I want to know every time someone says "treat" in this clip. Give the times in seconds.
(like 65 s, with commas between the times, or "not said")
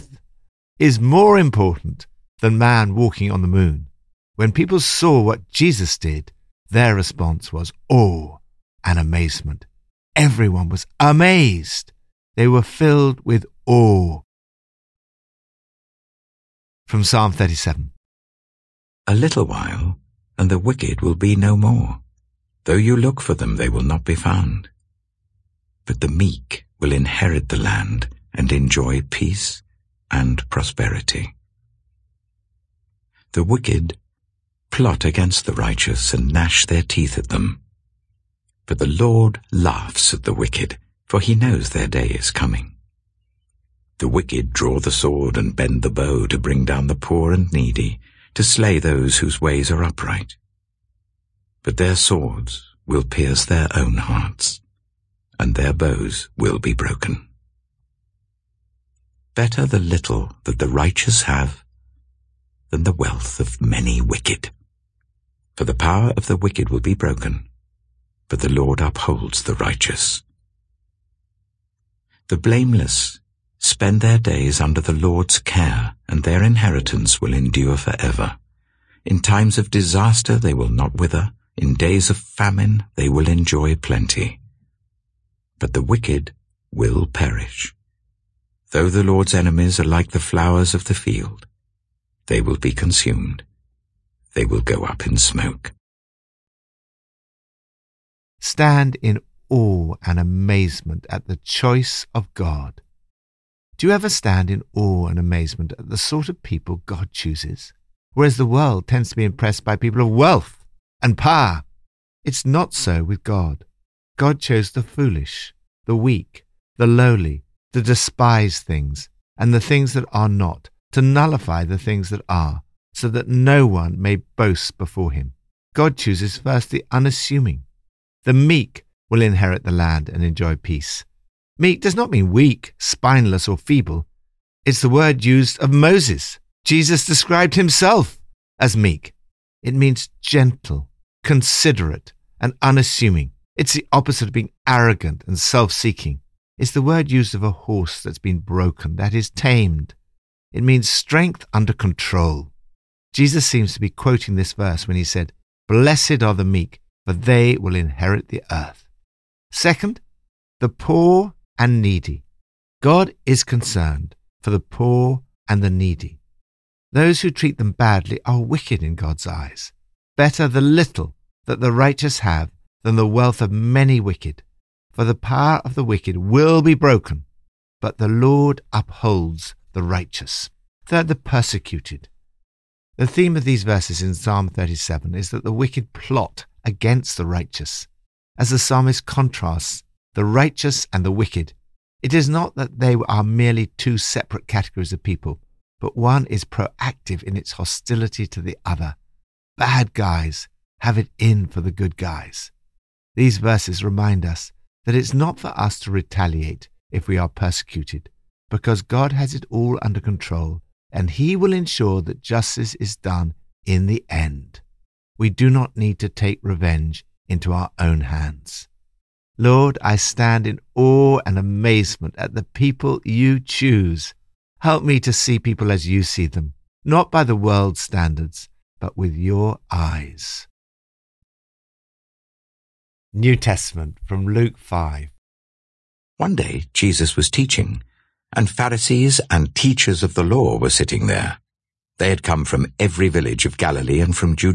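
167 s.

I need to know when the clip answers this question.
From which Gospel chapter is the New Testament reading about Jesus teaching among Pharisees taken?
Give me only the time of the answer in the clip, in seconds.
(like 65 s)
234 s.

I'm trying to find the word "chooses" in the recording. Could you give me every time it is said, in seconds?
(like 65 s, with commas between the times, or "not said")
107 s, 125 s, 223 s.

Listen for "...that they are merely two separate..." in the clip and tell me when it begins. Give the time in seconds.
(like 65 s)
192 s.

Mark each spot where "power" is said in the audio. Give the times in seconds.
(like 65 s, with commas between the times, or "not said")
65 s, 111 s, 175 s.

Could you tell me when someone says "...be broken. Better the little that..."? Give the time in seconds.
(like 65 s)
56 s.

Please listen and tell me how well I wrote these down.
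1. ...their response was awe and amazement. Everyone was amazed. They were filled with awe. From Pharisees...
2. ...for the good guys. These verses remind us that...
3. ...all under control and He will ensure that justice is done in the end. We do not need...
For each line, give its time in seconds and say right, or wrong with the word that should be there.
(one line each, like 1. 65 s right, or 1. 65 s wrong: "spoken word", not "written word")
1. 6 s wrong: "Psalm", not "Pharisees"
2. 201 s right
3. 209 s right.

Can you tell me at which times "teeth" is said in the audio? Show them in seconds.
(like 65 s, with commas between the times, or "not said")
36 s.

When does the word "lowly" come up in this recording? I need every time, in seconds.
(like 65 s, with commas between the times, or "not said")
116 s.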